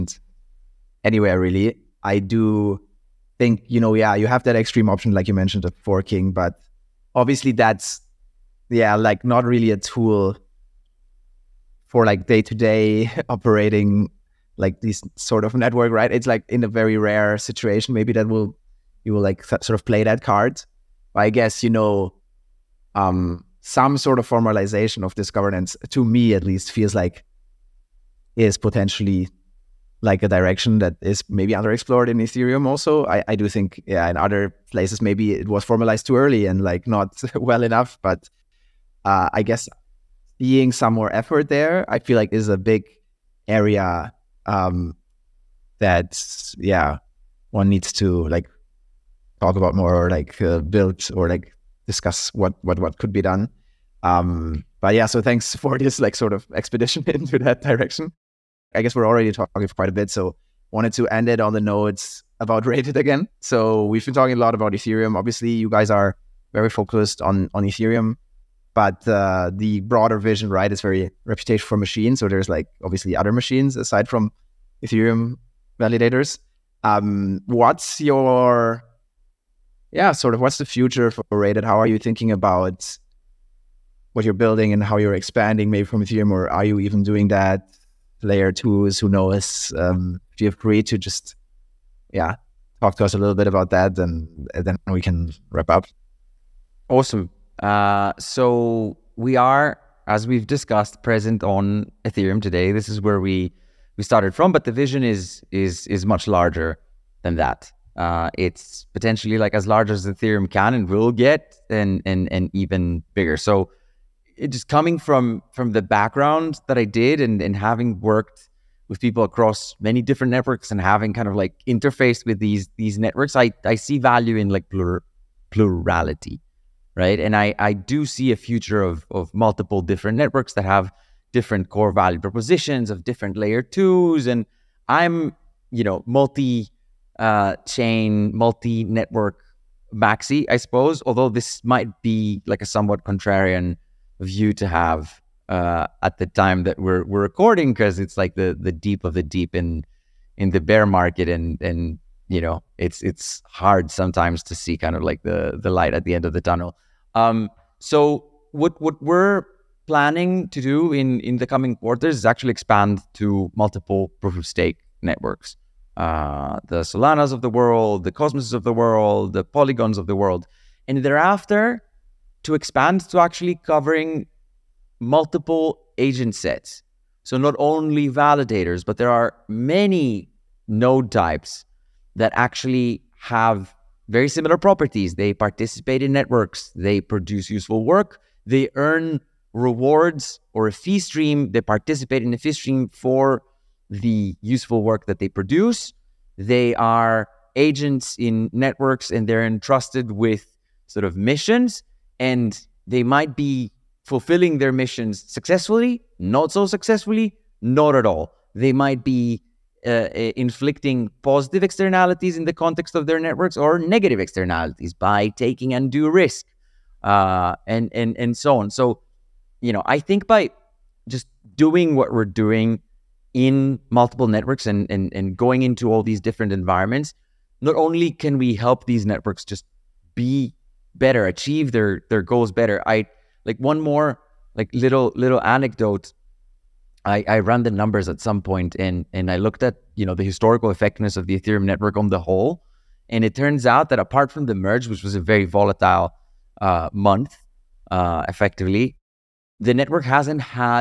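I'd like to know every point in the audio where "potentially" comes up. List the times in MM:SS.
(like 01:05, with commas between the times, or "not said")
00:28, 01:48.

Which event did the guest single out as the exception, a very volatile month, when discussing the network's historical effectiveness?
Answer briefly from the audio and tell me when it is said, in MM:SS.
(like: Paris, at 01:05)
The merge, at 04:04.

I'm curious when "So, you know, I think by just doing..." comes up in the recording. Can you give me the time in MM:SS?
03:38.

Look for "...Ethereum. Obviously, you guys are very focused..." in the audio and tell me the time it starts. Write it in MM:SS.
01:04.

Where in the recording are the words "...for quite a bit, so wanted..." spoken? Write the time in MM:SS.
00:59.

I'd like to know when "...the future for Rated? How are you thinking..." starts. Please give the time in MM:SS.
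01:20.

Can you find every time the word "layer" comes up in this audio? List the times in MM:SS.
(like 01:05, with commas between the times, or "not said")
01:28, 02:13.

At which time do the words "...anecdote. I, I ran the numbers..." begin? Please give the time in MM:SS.
03:55.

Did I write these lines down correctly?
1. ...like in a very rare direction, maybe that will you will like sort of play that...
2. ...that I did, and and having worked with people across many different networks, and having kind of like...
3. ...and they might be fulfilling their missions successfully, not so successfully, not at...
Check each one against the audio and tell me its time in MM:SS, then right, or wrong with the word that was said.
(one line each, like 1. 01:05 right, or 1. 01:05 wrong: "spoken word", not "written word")
1. 00:16 wrong: "situation", not "direction"
2. 01:56 right
3. 03:22 right.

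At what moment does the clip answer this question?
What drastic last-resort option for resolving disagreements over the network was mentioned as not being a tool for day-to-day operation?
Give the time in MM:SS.
00:05.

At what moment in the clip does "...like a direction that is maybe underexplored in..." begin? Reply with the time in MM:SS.
00:30.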